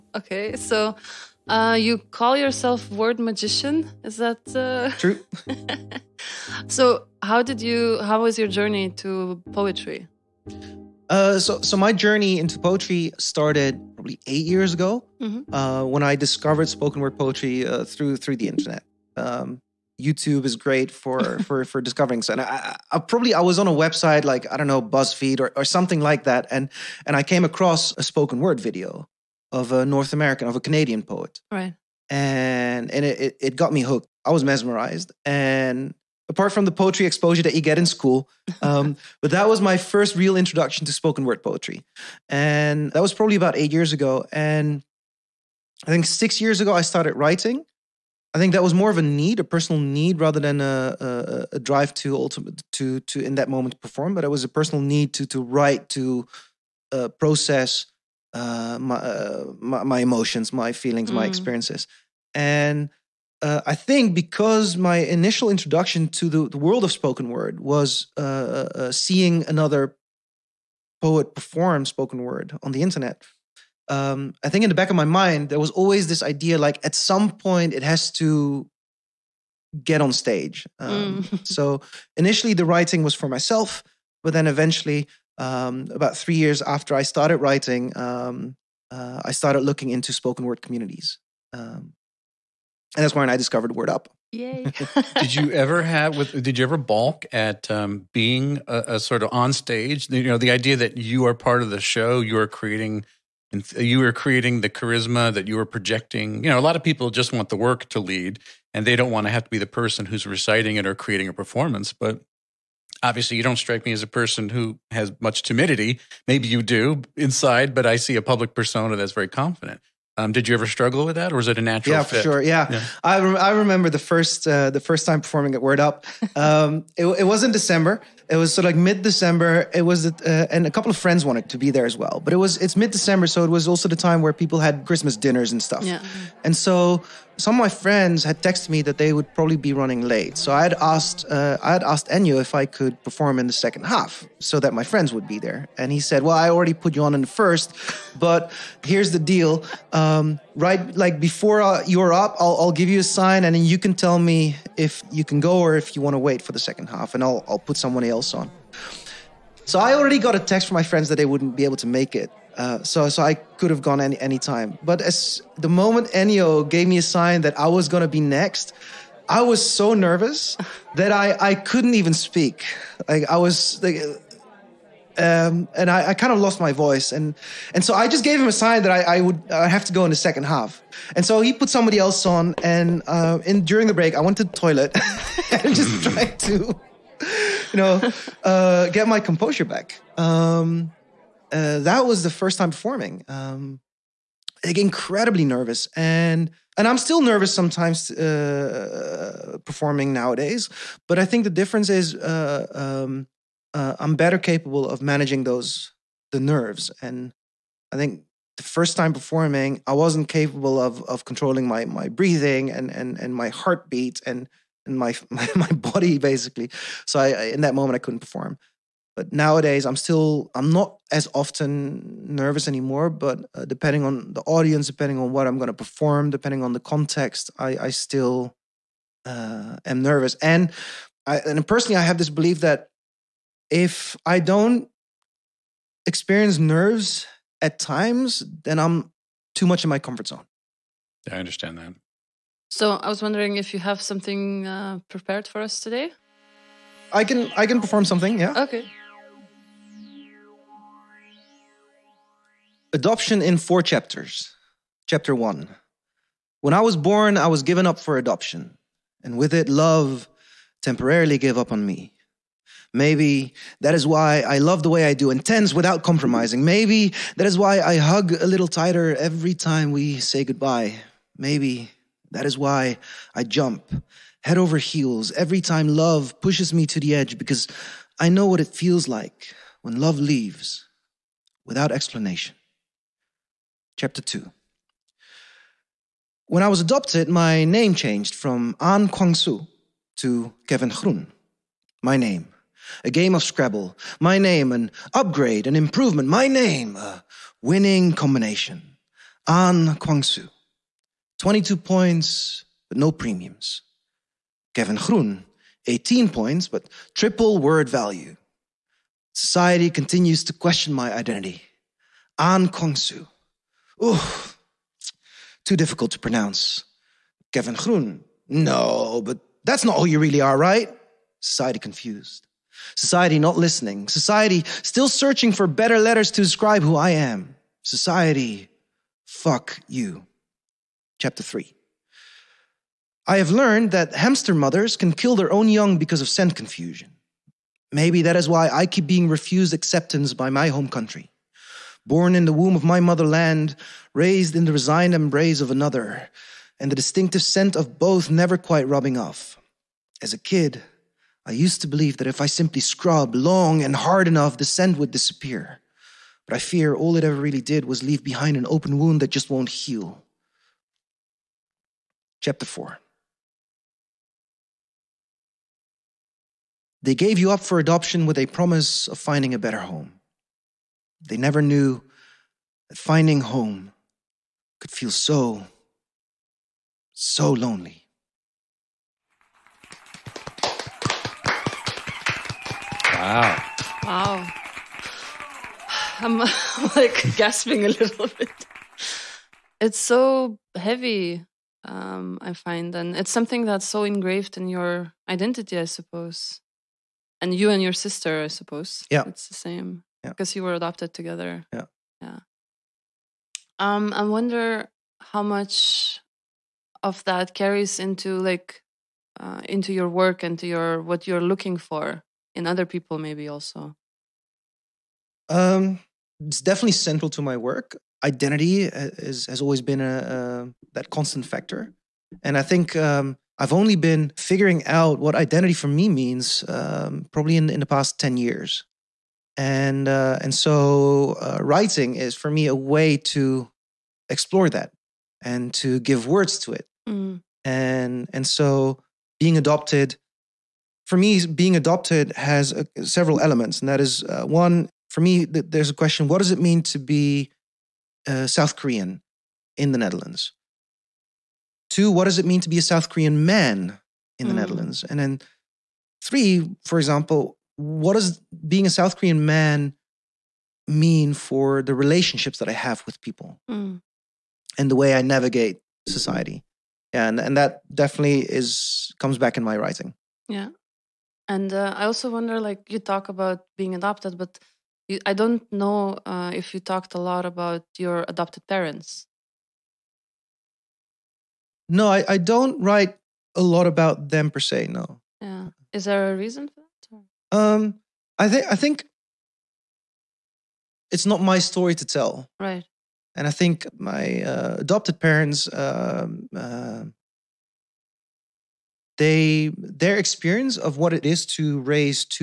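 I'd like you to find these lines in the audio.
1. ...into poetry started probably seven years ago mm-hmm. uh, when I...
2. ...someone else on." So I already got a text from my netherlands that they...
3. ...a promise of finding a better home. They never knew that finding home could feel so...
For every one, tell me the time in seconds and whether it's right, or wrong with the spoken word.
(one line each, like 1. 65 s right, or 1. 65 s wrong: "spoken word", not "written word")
1. 12 s wrong: "eight", not "seven"
2. 157 s wrong: "friends", not "netherlands"
3. 368 s right.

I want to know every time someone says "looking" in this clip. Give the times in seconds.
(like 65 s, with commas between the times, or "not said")
89 s, 411 s.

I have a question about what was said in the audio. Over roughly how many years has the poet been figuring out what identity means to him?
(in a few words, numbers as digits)
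10 years.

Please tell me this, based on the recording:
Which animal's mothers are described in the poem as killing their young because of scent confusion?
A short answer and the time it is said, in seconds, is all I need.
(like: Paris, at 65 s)
Hamster, at 334 s.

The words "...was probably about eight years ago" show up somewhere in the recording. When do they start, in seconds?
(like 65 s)
43 s.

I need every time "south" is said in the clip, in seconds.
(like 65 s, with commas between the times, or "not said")
448 s, 452 s, 458 s.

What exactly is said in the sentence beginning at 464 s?
and the way I navigate society?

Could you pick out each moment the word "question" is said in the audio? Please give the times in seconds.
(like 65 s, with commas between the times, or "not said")
310 s, 445 s.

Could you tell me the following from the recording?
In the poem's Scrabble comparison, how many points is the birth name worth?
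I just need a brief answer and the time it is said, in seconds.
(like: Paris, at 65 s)
22, at 301 s.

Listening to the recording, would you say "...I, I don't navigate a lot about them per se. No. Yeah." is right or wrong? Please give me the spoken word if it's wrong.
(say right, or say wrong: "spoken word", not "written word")
wrong: "write", not "navigate".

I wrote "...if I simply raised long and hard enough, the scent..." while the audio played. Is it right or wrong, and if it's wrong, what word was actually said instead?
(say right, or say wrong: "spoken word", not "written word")
wrong: "scrubbed", not "raised".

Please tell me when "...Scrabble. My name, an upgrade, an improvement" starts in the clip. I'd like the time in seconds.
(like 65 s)
293 s.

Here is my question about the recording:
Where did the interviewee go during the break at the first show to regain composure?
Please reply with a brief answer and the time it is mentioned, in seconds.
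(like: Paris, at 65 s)
The toilet, at 184 s.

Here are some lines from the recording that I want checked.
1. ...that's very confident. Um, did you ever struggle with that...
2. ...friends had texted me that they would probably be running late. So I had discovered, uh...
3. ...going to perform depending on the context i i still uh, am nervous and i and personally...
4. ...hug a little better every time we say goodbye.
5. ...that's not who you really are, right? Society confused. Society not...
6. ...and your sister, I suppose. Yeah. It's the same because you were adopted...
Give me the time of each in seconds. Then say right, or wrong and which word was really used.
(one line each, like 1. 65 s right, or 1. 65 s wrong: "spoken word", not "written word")
1. 118 s right
2. 137 s wrong: "asked", not "discovered"
3. 225 s right
4. 267 s wrong: "tighter", not "better"
5. 319 s right
6. 397 s right.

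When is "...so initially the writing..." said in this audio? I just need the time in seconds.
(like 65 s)
81 s.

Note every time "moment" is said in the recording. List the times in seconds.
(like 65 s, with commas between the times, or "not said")
53 s, 165 s, 217 s.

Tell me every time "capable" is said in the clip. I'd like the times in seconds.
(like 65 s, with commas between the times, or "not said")
204 s, 210 s.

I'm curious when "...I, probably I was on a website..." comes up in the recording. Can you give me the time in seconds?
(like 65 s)
22 s.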